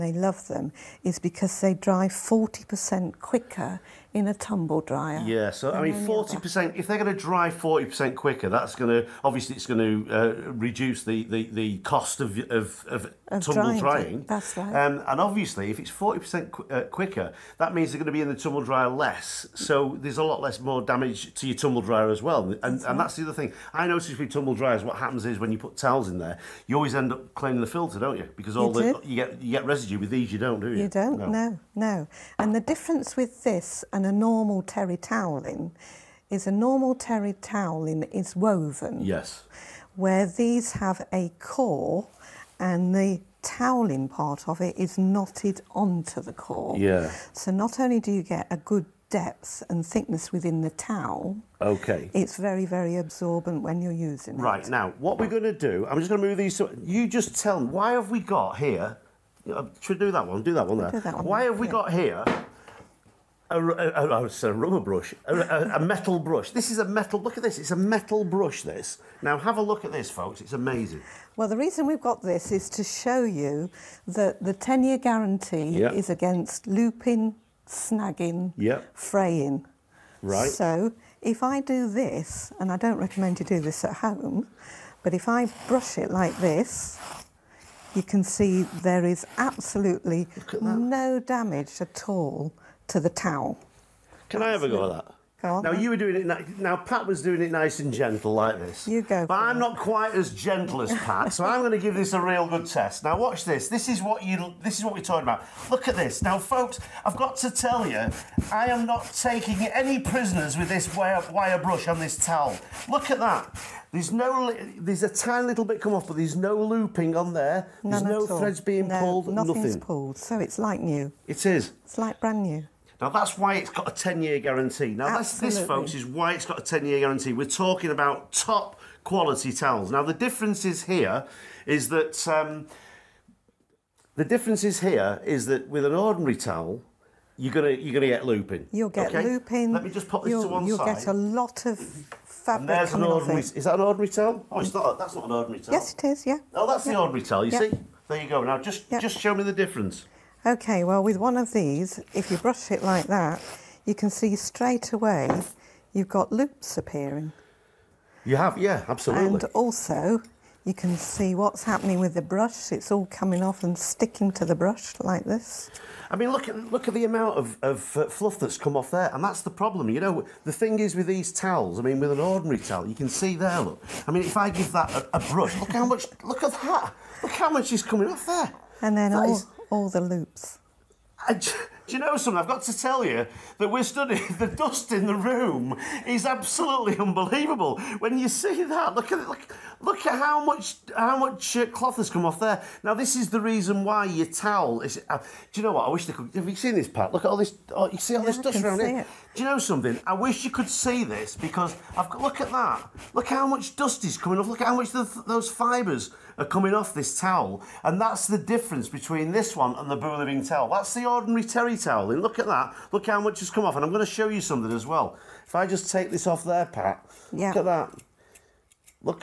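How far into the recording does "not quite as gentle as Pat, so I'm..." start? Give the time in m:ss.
1:39.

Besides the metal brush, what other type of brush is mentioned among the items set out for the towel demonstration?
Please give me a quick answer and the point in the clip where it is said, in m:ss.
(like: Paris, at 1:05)
rubber brush, at 1:04.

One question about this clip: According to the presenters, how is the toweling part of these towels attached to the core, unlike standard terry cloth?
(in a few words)
knotted.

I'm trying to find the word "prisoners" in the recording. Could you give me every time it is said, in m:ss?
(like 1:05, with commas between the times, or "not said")
1:49.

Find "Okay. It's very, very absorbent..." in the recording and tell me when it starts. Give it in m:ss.
0:51.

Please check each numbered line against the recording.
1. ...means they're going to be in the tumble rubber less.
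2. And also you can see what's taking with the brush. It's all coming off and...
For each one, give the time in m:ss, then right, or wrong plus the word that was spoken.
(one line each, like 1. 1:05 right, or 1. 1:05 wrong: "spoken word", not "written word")
1. 0:17 wrong: "dryer", not "rubber"
2. 2:39 wrong: "happening", not "taking".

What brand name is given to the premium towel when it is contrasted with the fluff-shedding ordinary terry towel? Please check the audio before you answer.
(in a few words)
Boo Living.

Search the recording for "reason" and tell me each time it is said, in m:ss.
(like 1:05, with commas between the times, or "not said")
1:11, 3:13.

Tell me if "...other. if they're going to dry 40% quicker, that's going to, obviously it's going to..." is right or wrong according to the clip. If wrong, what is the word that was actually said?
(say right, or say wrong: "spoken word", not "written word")
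right.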